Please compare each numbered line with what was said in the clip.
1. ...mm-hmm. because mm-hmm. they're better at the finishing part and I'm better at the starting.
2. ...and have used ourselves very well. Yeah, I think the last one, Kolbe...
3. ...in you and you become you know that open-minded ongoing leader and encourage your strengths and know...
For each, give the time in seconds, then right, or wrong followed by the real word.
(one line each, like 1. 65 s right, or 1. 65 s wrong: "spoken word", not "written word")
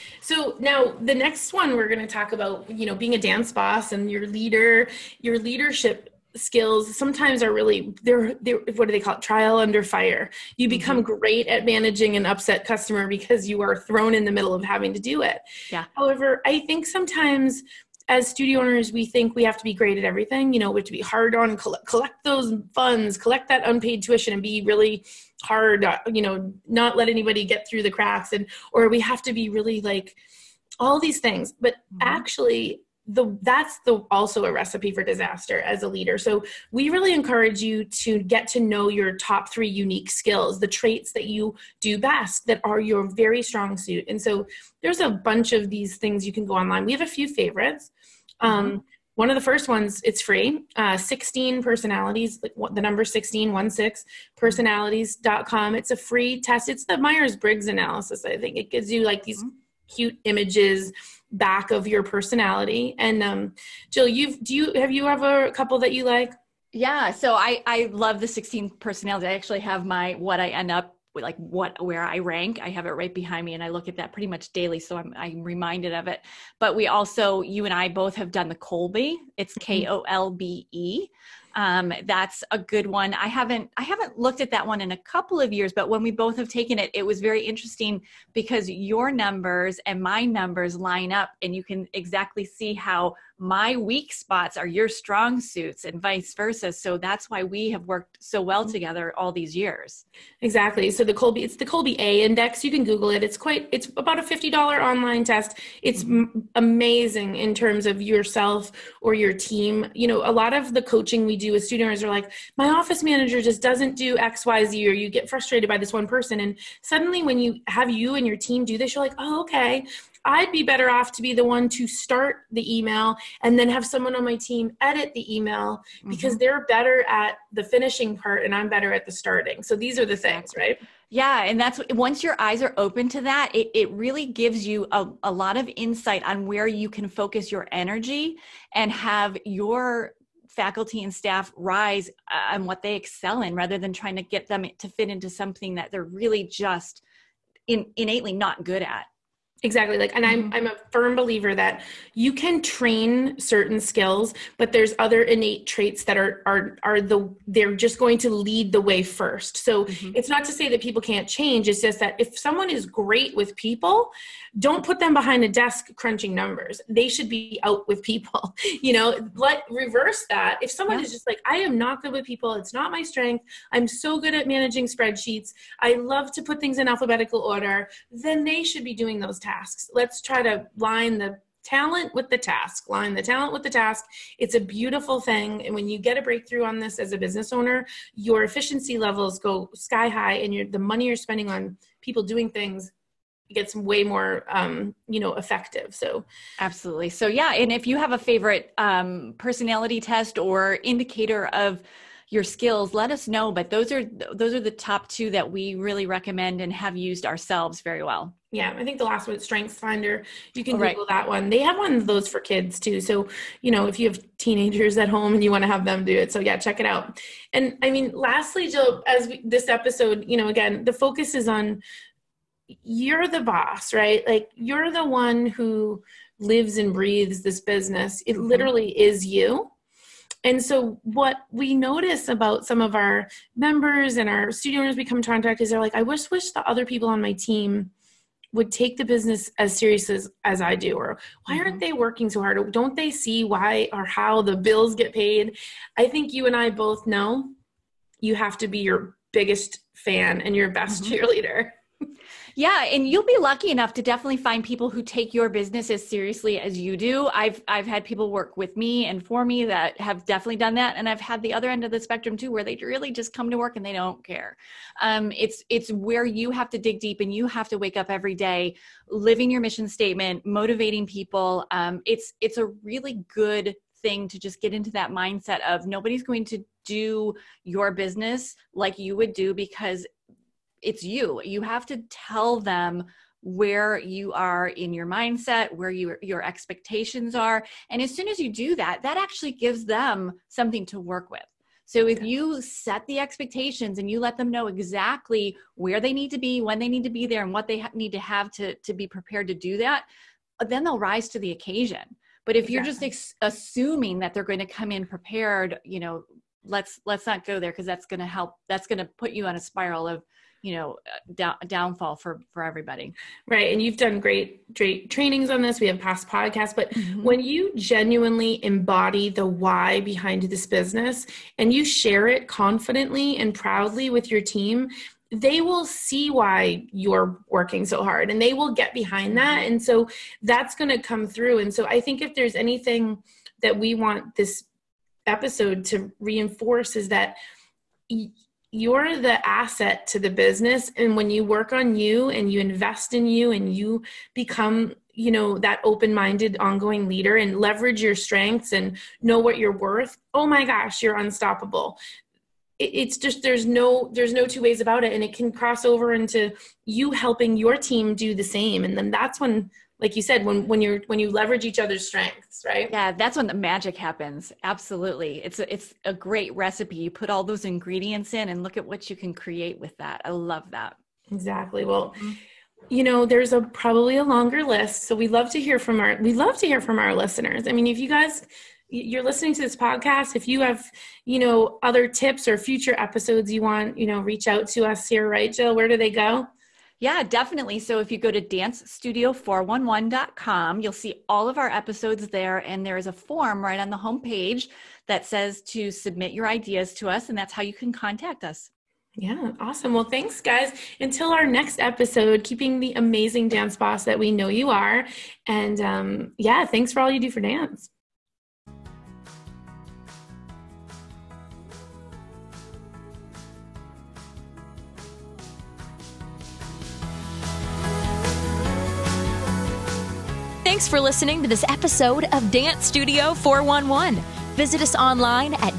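1. 125 s right
2. 206 s wrong: "Strengths", not "Kolbe"
3. 343 s wrong: "leverage", not "encourage".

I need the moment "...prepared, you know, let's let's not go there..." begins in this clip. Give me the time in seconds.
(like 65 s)
305 s.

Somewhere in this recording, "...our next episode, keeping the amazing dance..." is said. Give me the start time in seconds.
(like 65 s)
401 s.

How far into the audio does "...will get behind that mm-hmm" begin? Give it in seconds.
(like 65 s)
328 s.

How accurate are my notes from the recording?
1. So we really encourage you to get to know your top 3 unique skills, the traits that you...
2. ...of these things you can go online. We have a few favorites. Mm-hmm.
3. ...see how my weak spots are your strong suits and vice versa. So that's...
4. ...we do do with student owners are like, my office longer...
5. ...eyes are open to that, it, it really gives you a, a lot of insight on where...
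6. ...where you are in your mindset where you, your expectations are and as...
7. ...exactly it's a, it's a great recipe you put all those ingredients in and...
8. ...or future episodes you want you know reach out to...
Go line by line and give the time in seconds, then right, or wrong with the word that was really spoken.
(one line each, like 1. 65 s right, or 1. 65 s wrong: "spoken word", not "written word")
1. 36 s right
2. 45 s right
3. 92 s right
4. 111 s wrong: "manager", not "longer"
5. 132 s right
6. 283 s right
7. 364 s wrong: "absolutely", not "exactly"
8. 382 s right.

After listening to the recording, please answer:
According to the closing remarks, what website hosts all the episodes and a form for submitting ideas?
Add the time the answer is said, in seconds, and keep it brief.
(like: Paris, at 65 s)
dancestudio411.com, at 388 s.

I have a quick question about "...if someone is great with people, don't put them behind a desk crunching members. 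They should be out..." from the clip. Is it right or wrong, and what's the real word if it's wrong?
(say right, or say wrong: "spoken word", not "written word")
wrong: "numbers", not "members".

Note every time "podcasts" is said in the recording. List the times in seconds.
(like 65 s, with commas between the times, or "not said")
316 s, 379 s.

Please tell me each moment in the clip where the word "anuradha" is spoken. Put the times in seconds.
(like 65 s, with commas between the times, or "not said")
not said.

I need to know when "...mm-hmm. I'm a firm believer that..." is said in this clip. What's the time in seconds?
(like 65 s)
150 s.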